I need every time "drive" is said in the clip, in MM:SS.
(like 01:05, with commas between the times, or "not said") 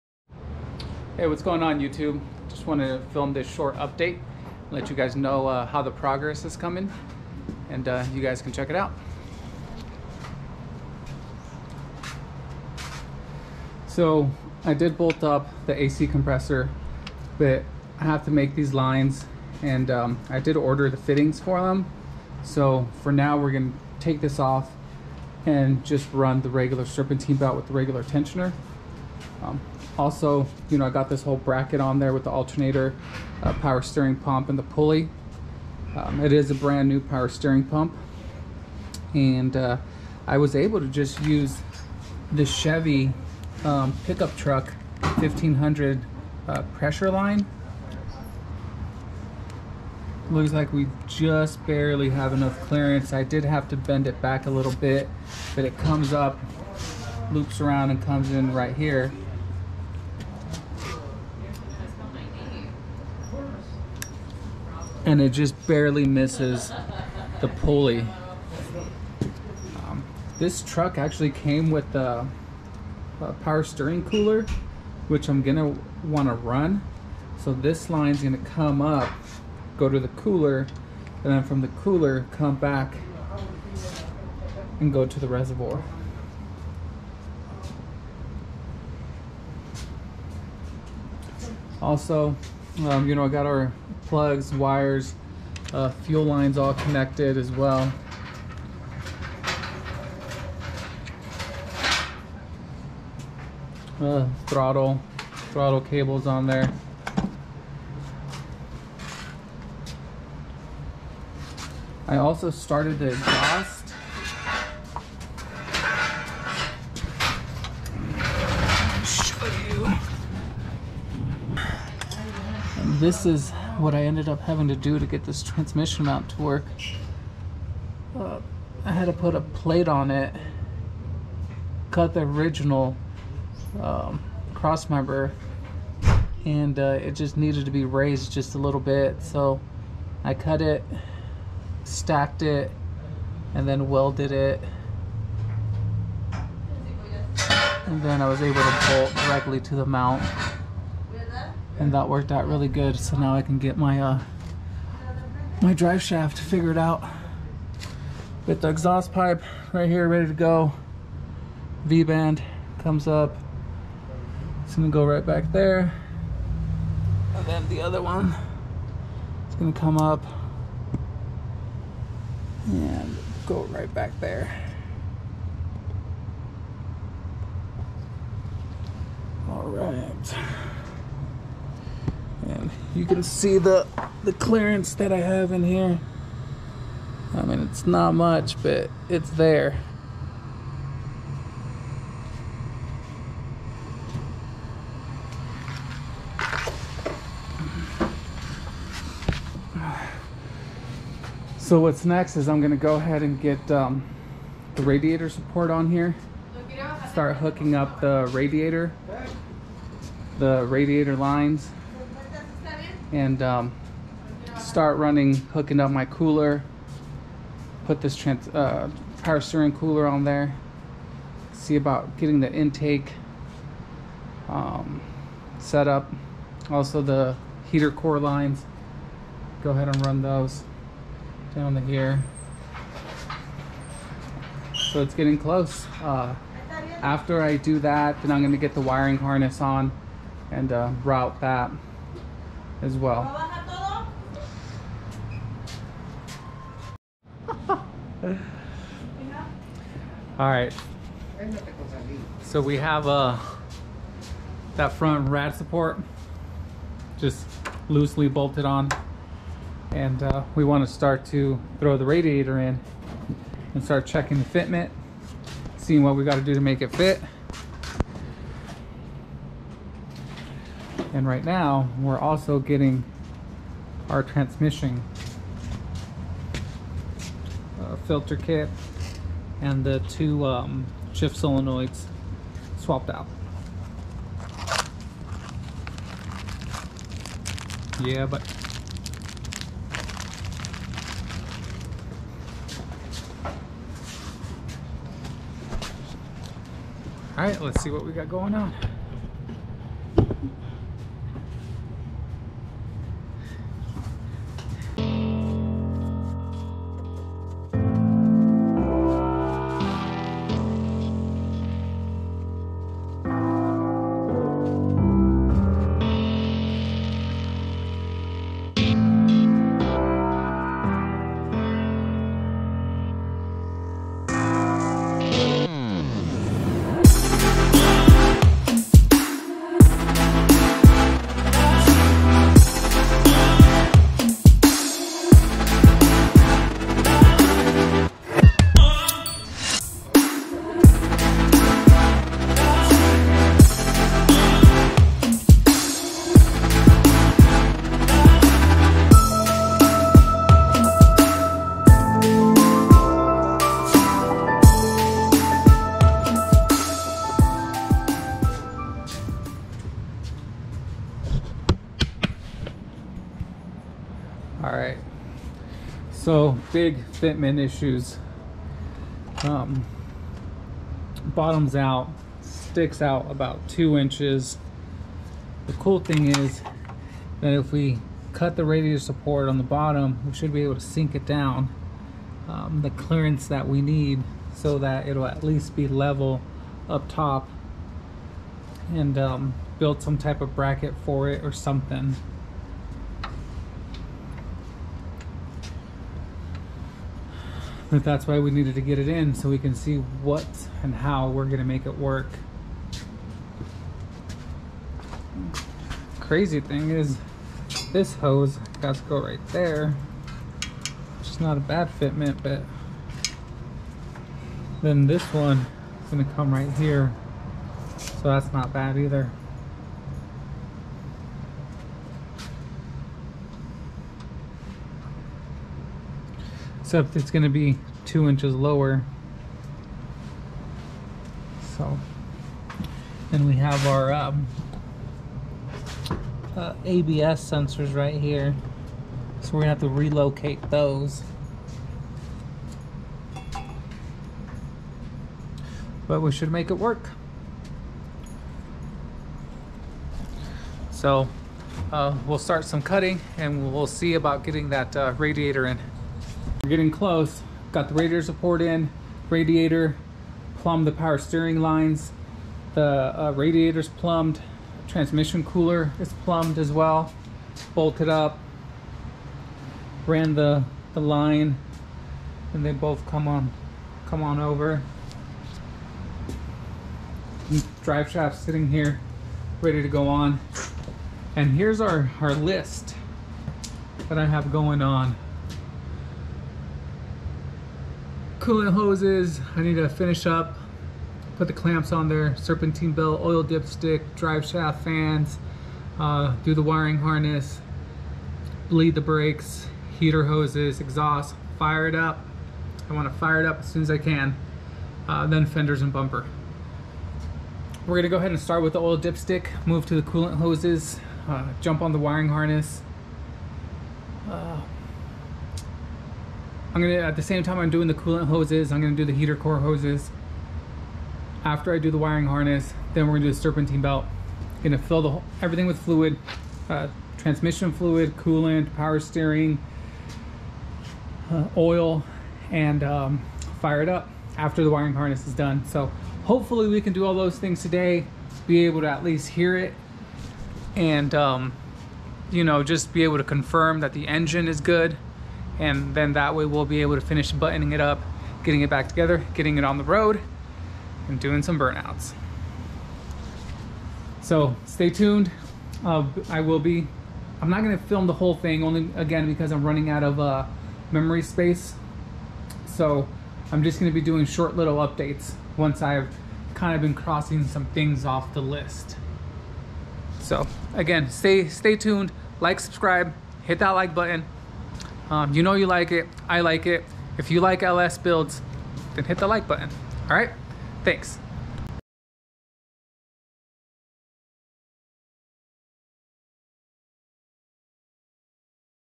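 02:35, 07:57, 08:14.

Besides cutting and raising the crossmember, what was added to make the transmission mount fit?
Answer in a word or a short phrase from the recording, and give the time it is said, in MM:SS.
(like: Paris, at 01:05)
a plate, at 02:09.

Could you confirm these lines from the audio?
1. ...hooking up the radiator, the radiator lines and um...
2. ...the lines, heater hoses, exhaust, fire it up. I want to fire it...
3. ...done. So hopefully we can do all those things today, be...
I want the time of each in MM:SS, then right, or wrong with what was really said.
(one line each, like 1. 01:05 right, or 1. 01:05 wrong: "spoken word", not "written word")
1. 03:27 right
2. 08:18 wrong: "brakes", not "lines"
3. 08:55 right.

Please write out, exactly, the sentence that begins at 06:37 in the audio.
But that's why we needed to get it in so we can see what and how we're gonna make it work.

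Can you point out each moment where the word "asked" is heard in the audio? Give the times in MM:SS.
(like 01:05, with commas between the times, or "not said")
not said.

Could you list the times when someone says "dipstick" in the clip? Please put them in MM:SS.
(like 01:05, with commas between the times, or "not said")
08:13, 08:28.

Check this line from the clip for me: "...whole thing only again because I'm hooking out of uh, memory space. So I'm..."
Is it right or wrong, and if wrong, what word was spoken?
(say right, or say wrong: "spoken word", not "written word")
wrong: "running", not "hooking".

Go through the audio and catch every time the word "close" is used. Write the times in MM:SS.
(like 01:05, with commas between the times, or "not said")
03:55, 07:36.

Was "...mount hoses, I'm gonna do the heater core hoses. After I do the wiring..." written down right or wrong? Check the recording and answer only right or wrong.
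wrong.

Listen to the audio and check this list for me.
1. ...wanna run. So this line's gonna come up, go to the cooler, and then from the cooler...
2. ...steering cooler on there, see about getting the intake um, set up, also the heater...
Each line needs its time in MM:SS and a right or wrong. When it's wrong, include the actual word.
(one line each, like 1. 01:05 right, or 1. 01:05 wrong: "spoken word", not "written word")
1. 01:16 right
2. 03:39 right.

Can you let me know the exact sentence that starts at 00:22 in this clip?
So for now, we're gonna take this off and just run the regular serpentine belt with the regular tensioner.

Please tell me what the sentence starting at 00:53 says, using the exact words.
I did have to bend it back a little bit, but it comes up, loops around and comes in right here.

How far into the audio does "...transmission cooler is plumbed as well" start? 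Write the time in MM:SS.
07:44.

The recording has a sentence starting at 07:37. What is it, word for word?
Got the radiator support in, radiator, plumbed the power steering lines.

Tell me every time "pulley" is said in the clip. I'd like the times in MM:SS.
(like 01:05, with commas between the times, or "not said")
00:34, 01:07.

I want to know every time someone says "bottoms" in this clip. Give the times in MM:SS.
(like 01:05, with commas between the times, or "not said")
06:11, 06:19.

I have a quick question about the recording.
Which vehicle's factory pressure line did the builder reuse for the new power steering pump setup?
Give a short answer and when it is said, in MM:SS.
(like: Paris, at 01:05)
Chevy 1500 pickup truck, at 00:42.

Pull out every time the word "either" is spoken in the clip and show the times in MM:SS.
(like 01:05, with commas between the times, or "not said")
06:58.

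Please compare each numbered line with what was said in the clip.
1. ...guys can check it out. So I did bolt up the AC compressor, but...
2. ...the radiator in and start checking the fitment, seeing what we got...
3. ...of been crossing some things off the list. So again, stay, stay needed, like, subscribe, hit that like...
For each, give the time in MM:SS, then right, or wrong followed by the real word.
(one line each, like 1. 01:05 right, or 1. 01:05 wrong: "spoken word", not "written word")
1. 00:08 right
2. 04:21 right
3. 09:26 wrong: "tuned", not "needed".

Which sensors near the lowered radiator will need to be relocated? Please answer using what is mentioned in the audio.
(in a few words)
ABS sensors.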